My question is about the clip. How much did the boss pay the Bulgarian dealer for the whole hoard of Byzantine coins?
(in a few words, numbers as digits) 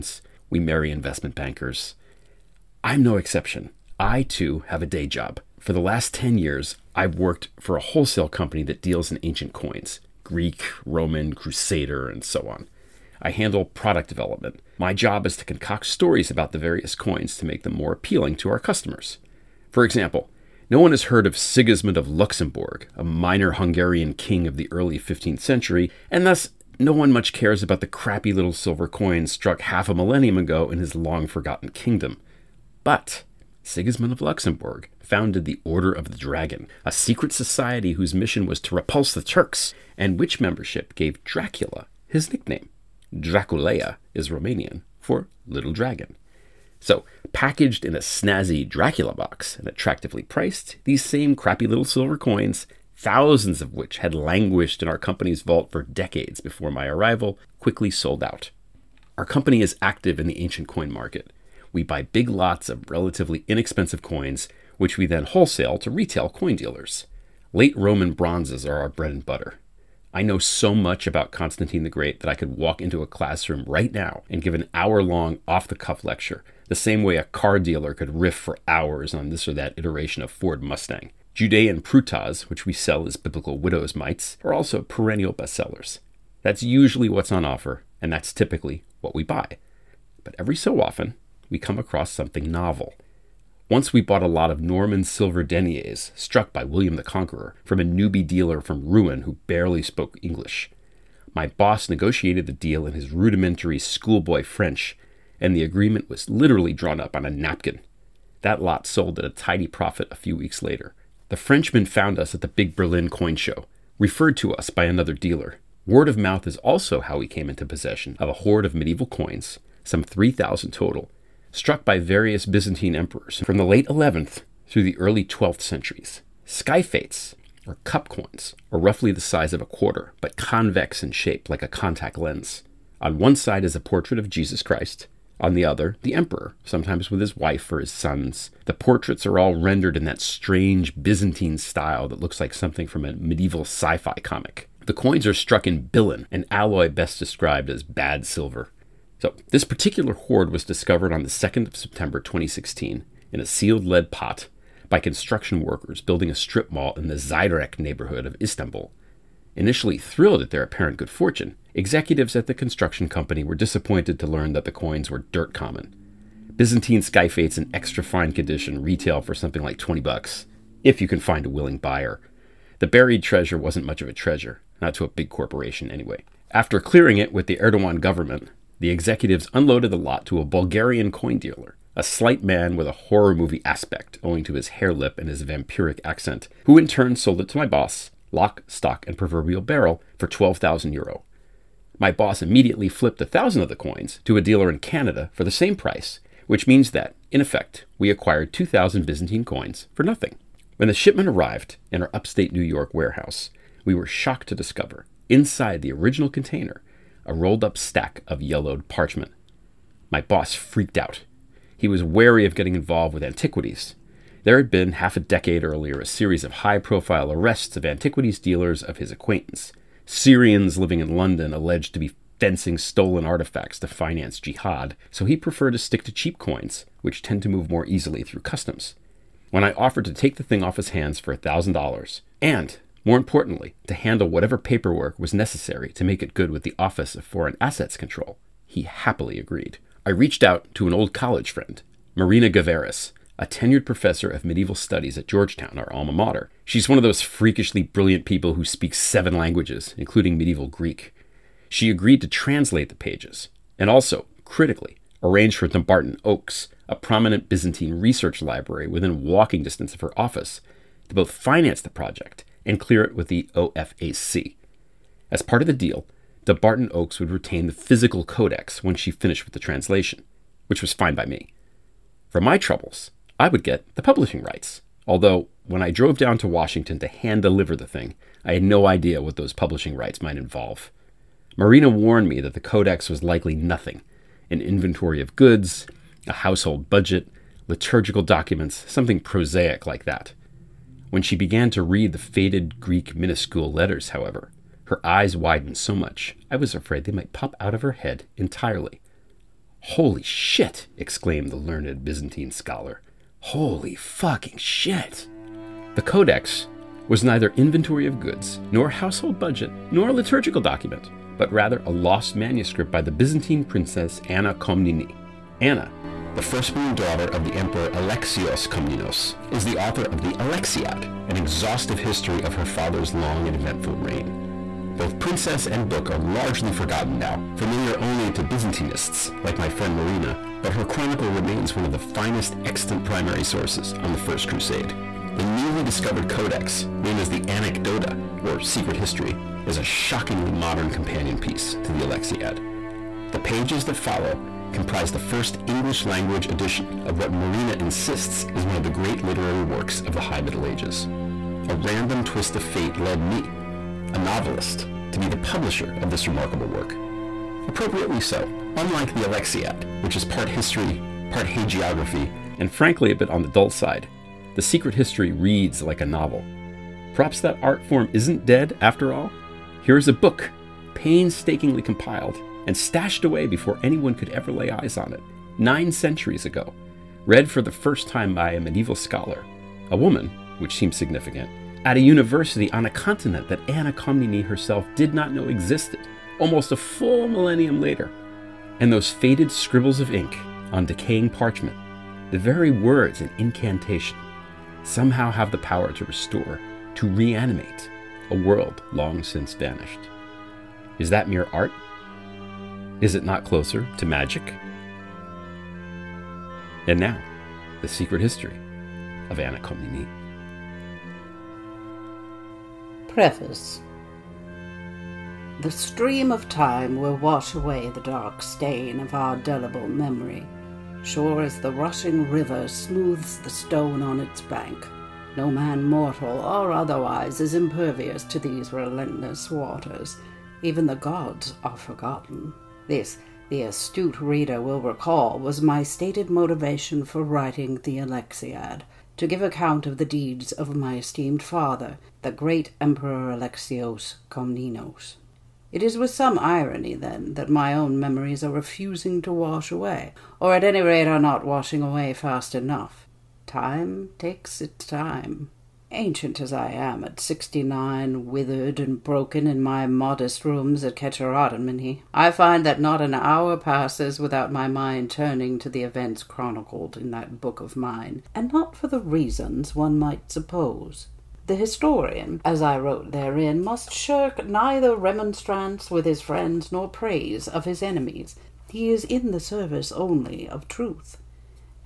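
12,000 euro.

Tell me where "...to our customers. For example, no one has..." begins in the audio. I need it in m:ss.
0:18.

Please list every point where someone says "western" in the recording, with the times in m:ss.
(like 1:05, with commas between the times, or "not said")
not said.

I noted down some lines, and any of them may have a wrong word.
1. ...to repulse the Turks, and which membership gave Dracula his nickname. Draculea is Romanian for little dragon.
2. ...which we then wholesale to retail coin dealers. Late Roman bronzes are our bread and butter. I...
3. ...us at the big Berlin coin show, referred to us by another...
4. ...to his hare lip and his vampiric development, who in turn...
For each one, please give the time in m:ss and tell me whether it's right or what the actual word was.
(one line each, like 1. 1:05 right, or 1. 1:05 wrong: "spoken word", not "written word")
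1. 0:38 right
2. 1:04 right
3. 1:52 right
4. 3:04 wrong: "accent", not "development".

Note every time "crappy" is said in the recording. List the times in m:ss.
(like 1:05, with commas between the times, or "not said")
0:27, 0:51.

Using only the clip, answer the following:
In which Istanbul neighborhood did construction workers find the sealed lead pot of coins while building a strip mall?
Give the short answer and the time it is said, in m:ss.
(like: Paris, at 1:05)
Zeyrek, at 2:37.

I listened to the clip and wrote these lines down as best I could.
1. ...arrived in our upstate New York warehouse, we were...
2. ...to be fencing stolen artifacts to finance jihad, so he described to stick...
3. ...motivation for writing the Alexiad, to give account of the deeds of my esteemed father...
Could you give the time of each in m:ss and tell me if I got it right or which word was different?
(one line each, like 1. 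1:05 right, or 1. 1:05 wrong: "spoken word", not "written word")
1. 3:21 right
2. 3:41 wrong: "preferred", not "described"
3. 7:16 right.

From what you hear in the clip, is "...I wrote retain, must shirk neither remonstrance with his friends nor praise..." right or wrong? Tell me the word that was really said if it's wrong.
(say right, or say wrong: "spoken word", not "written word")
wrong: "therein", not "retain".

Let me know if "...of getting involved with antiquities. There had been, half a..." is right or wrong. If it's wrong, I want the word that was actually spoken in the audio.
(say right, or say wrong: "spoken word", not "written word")
right.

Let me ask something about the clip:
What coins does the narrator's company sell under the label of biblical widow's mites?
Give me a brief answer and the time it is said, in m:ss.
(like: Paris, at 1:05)
Judean prutas, at 1:21.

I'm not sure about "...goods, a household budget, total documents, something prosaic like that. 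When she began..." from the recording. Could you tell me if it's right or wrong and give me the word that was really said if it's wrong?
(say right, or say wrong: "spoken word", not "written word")
wrong: "liturgical", not "total".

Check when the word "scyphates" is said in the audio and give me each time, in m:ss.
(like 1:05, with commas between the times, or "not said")
2:06, 2:47.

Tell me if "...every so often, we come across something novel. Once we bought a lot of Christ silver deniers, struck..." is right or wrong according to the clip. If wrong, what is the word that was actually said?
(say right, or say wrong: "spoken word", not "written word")
wrong: "Norman", not "Christ".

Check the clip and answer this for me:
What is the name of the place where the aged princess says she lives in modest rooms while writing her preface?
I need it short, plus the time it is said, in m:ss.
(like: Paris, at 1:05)
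Kecharitomene, at 7:40.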